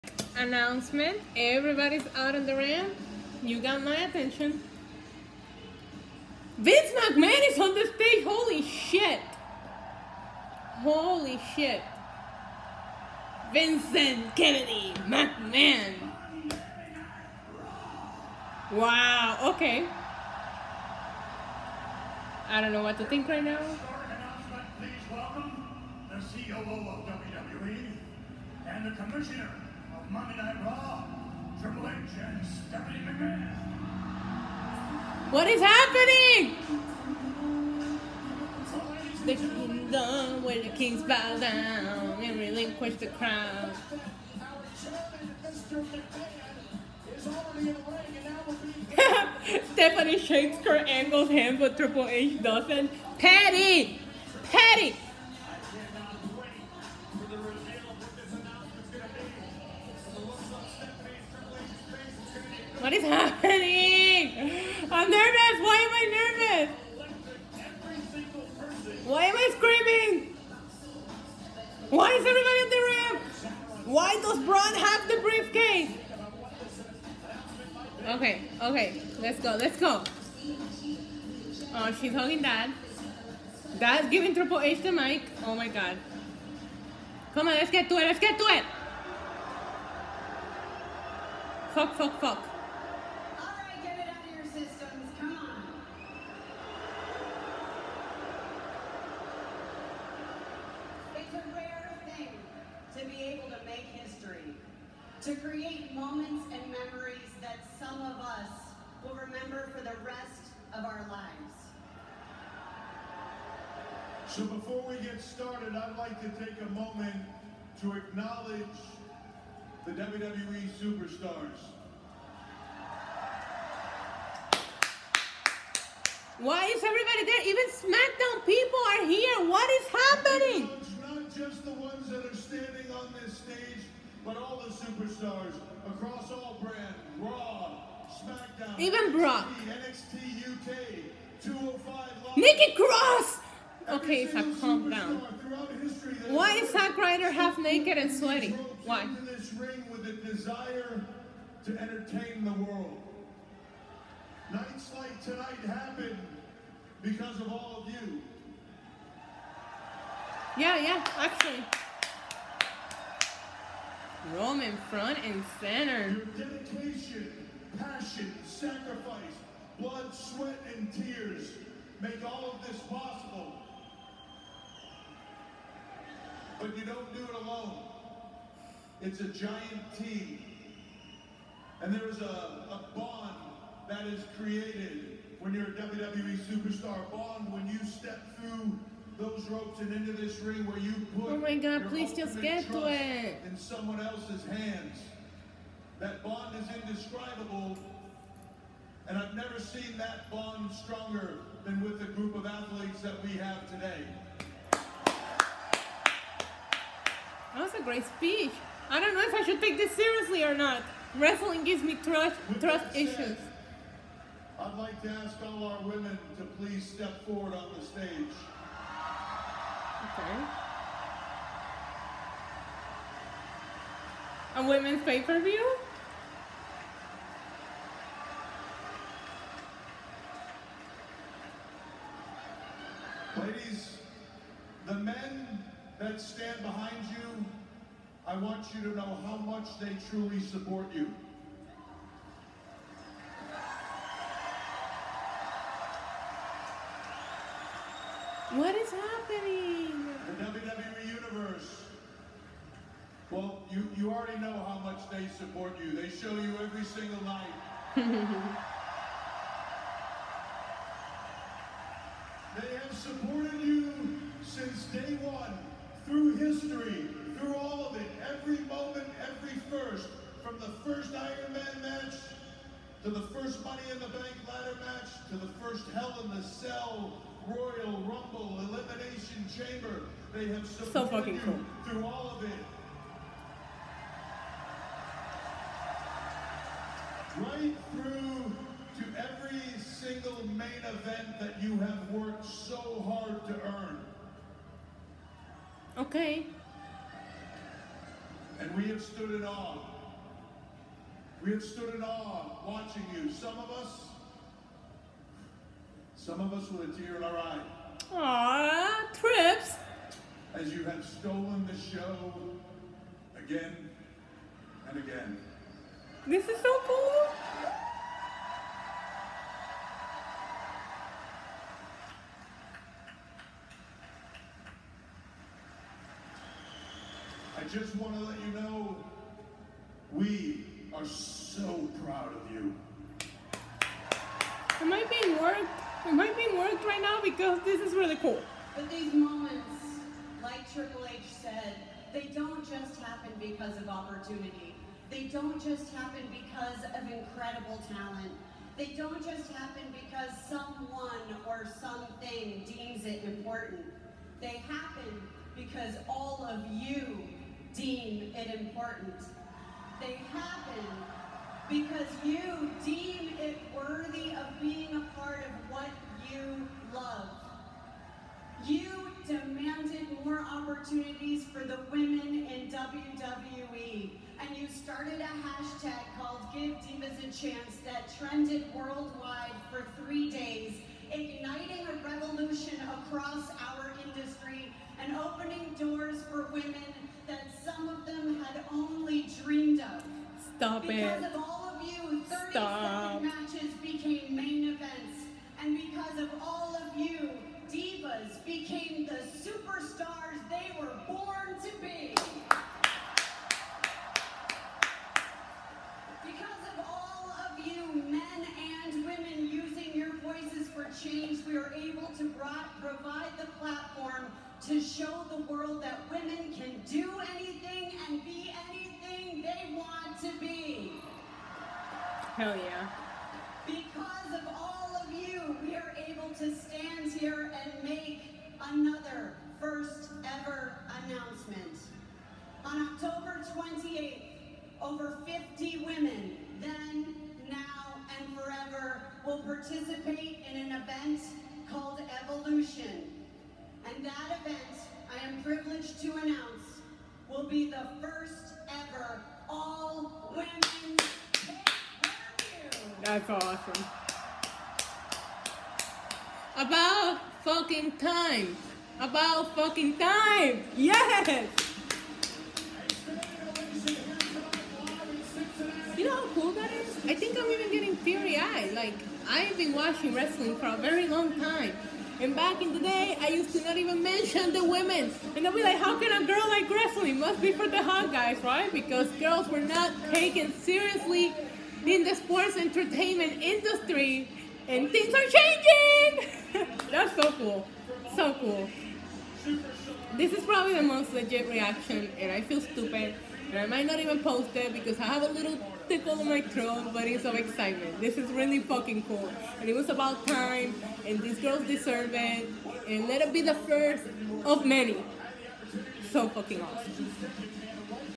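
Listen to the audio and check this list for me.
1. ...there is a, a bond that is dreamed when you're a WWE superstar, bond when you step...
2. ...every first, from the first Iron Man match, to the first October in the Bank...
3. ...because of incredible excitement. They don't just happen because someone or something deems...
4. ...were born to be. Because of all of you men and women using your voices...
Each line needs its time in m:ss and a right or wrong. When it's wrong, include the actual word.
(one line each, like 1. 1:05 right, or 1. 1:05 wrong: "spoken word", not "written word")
1. 3:01 wrong: "created", not "dreamed"
2. 4:29 wrong: "Money", not "October"
3. 5:46 wrong: "talent", not "excitement"
4. 6:40 right.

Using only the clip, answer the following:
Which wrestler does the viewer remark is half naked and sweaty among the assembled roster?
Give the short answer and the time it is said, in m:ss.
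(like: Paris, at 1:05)
Zack Ryder, at 2:26.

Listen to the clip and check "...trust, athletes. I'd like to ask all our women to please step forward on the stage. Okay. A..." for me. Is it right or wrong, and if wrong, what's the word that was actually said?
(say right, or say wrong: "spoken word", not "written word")
wrong: "issues", not "athletes".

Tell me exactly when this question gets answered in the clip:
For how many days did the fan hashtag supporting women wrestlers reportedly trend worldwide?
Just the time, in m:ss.
6:20.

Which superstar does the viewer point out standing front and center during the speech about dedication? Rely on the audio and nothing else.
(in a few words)
Roman.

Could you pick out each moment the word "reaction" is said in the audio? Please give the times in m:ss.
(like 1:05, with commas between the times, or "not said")
8:11.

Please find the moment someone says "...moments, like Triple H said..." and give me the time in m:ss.
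5:39.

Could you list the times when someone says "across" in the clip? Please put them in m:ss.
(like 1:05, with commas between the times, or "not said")
2:15, 6:23.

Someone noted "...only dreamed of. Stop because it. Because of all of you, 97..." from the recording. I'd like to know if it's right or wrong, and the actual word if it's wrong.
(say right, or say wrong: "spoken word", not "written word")
wrong: "37", not "97".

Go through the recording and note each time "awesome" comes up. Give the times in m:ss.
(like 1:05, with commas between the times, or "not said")
7:33, 8:26.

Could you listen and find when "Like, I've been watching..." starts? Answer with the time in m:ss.
7:48.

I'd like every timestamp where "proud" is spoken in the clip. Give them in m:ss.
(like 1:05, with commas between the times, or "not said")
5:32.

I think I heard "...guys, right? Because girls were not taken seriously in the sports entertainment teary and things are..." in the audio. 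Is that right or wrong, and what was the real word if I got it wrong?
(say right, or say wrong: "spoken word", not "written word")
wrong: "industry", not "teary".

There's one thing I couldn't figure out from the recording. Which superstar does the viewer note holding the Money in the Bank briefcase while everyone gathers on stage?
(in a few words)
Braun.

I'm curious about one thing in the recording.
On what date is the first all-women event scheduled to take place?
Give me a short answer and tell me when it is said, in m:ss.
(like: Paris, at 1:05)
October 28th, at 7:12.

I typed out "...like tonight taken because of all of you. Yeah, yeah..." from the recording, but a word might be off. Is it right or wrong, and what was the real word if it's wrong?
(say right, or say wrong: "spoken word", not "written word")
wrong: "happen", not "taken".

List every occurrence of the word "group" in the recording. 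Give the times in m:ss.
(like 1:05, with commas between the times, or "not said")
3:22.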